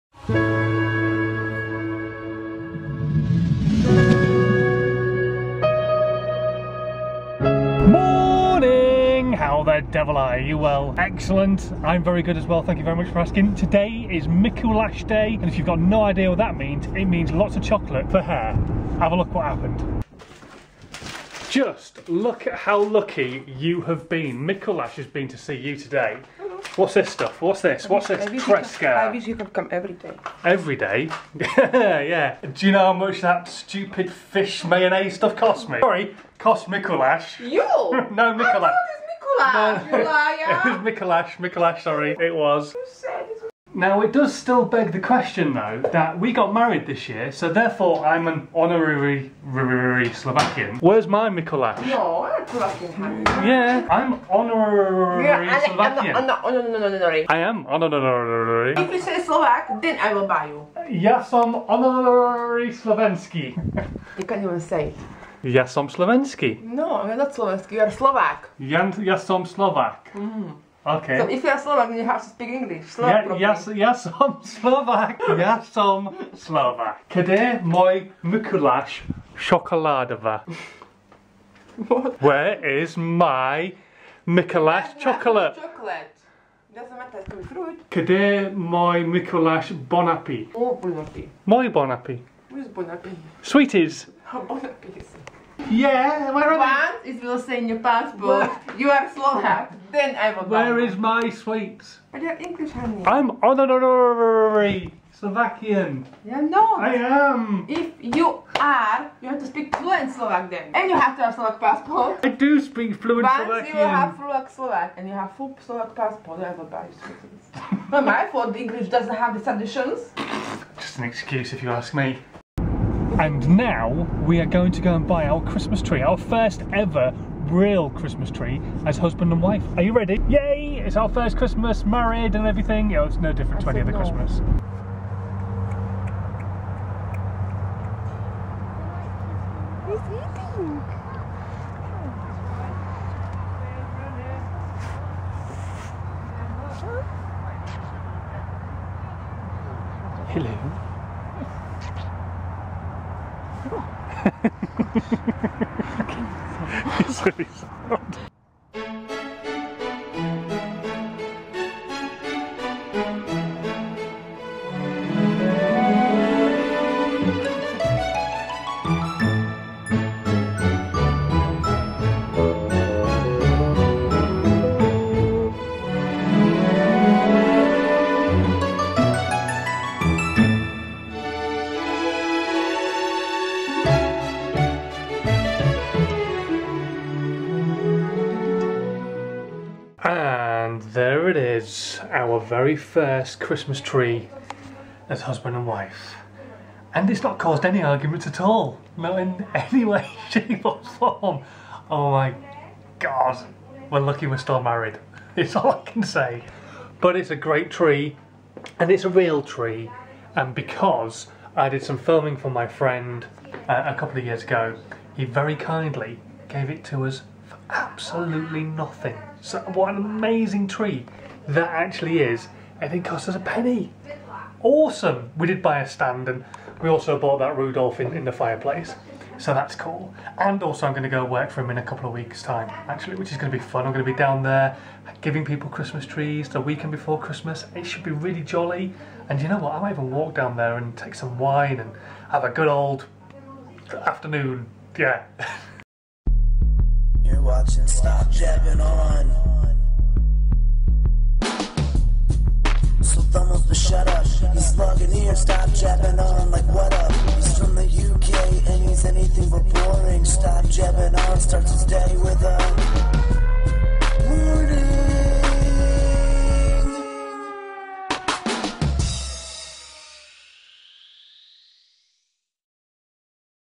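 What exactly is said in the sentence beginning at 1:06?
No, ja not slovenský, you're Slovak.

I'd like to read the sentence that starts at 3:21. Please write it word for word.
Oh my god, we're lucky we're still married.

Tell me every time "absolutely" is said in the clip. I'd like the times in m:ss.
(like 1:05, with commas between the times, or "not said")
3:37.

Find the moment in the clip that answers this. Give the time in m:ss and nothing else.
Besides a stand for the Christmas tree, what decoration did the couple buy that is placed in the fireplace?
3:47.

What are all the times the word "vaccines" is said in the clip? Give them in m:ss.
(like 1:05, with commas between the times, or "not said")
not said.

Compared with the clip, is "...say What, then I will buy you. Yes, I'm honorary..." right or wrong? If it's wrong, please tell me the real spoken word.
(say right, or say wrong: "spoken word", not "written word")
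wrong: "Slovak", not "What".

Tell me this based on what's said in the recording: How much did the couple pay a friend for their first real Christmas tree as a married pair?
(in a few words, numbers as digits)
a penny.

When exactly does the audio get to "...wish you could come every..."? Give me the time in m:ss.
0:29.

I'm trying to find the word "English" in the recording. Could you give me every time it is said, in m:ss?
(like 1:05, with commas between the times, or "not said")
1:12, 1:42, 1:58.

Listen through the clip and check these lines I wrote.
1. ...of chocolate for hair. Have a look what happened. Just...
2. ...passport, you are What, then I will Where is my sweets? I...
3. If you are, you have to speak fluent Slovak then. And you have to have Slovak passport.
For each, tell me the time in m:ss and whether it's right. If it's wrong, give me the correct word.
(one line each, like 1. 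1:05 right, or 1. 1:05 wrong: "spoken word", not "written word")
1. 0:17 right
2. 1:37 wrong: "Slovak", not "What"
3. 1:47 right.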